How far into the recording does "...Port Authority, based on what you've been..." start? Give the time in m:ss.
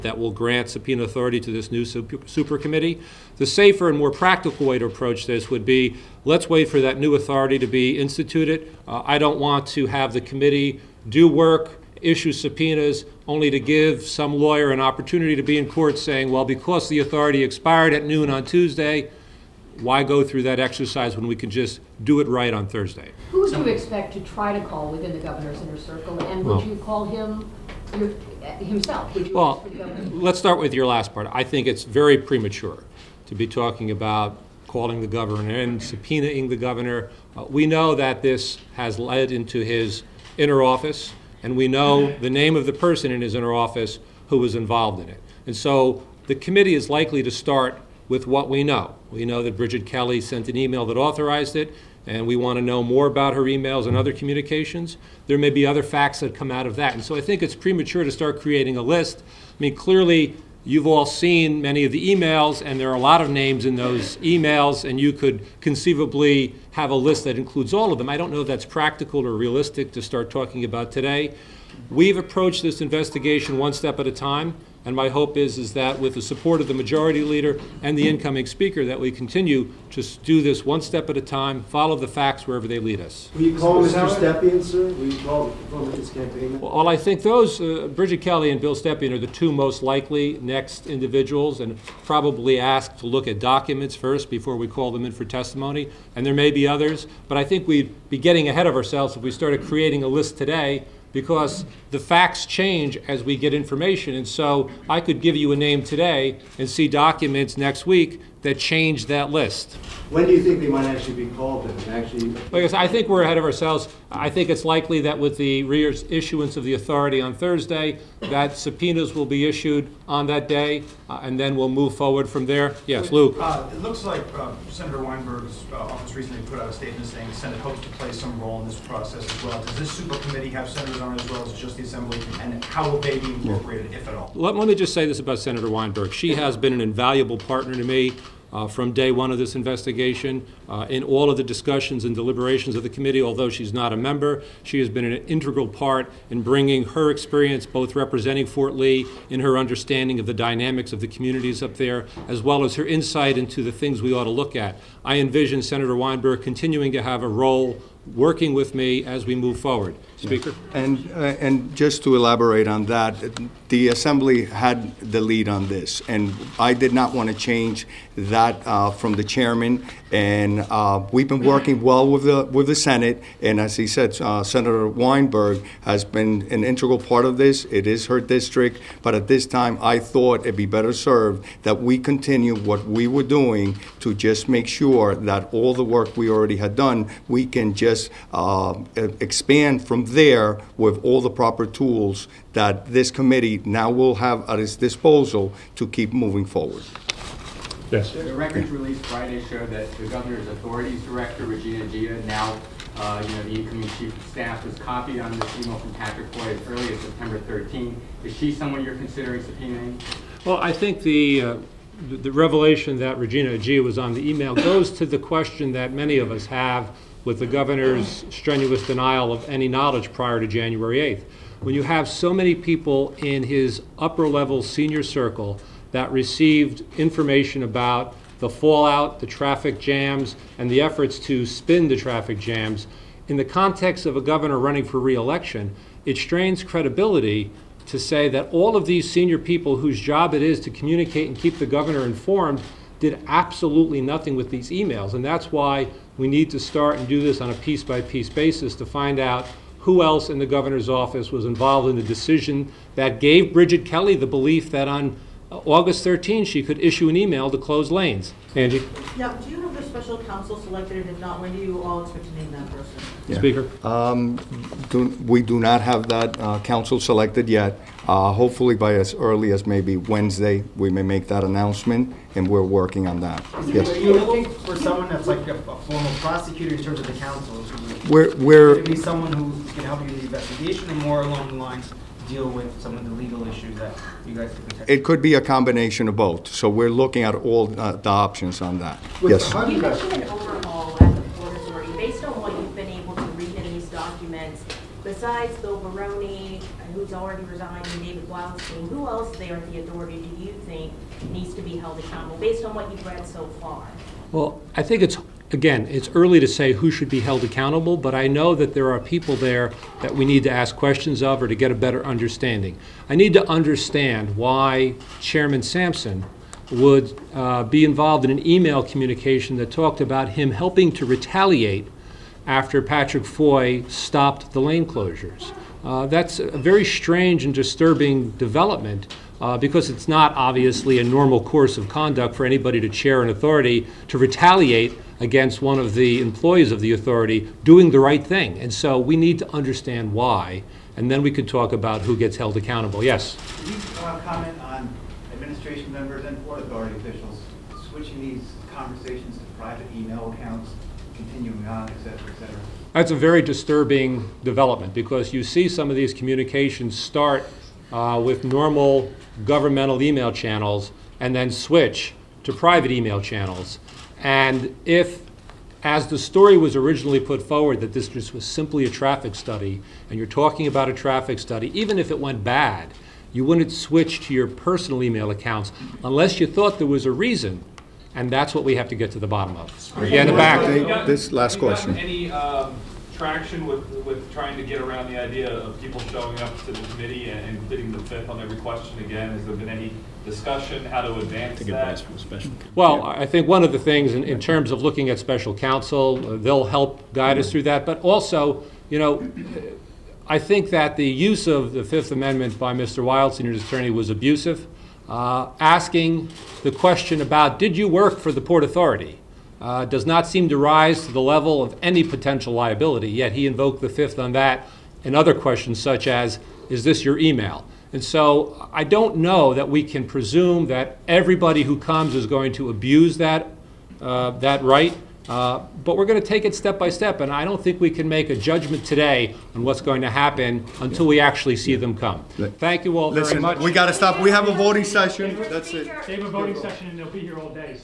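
4:51.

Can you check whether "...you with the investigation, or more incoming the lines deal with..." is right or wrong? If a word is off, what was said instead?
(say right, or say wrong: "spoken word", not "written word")
wrong: "along", not "incoming".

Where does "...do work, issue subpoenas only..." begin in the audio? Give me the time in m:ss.
0:11.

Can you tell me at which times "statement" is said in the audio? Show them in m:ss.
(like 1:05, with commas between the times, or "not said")
2:06.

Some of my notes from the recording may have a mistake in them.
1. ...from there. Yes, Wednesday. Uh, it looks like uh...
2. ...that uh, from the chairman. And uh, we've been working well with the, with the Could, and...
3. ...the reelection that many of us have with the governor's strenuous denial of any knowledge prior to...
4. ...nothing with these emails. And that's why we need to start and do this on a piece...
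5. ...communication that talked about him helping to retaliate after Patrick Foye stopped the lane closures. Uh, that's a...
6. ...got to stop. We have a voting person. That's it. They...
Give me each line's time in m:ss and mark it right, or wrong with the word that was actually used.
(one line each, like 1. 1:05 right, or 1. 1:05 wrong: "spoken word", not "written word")
1. 2:02 wrong: "Luke", not "Wednesday"
2. 2:48 wrong: "Senate", not "Could"
3. 3:35 wrong: "question", not "reelection"
4. 4:04 right
5. 5:18 right
6. 7:13 wrong: "session", not "person".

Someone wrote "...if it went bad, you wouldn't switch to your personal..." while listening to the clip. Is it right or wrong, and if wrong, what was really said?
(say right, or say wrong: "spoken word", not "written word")
right.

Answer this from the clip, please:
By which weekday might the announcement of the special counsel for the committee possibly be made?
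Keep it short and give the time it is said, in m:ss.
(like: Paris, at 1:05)
Wednesday, at 4:29.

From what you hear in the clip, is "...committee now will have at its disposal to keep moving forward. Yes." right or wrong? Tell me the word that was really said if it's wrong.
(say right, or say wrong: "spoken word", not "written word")
right.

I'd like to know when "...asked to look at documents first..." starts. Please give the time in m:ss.
1:32.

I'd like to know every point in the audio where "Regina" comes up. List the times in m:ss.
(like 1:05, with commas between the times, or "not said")
3:21, 3:33.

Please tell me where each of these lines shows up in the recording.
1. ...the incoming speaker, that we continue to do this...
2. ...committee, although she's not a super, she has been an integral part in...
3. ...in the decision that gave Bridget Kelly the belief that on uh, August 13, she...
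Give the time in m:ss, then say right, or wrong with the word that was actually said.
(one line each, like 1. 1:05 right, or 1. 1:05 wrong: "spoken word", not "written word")
1. 1:17 right
2. 2:22 wrong: "member", not "super"
3. 4:11 right.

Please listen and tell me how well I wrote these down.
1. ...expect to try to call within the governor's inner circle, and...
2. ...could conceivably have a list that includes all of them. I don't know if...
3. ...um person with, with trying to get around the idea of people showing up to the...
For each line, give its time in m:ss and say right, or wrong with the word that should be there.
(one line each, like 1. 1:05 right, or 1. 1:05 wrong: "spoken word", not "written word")
1. 0:23 right
2. 1:05 right
3. 6:22 wrong: "traction", not "person".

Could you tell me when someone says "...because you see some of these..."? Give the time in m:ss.
5:54.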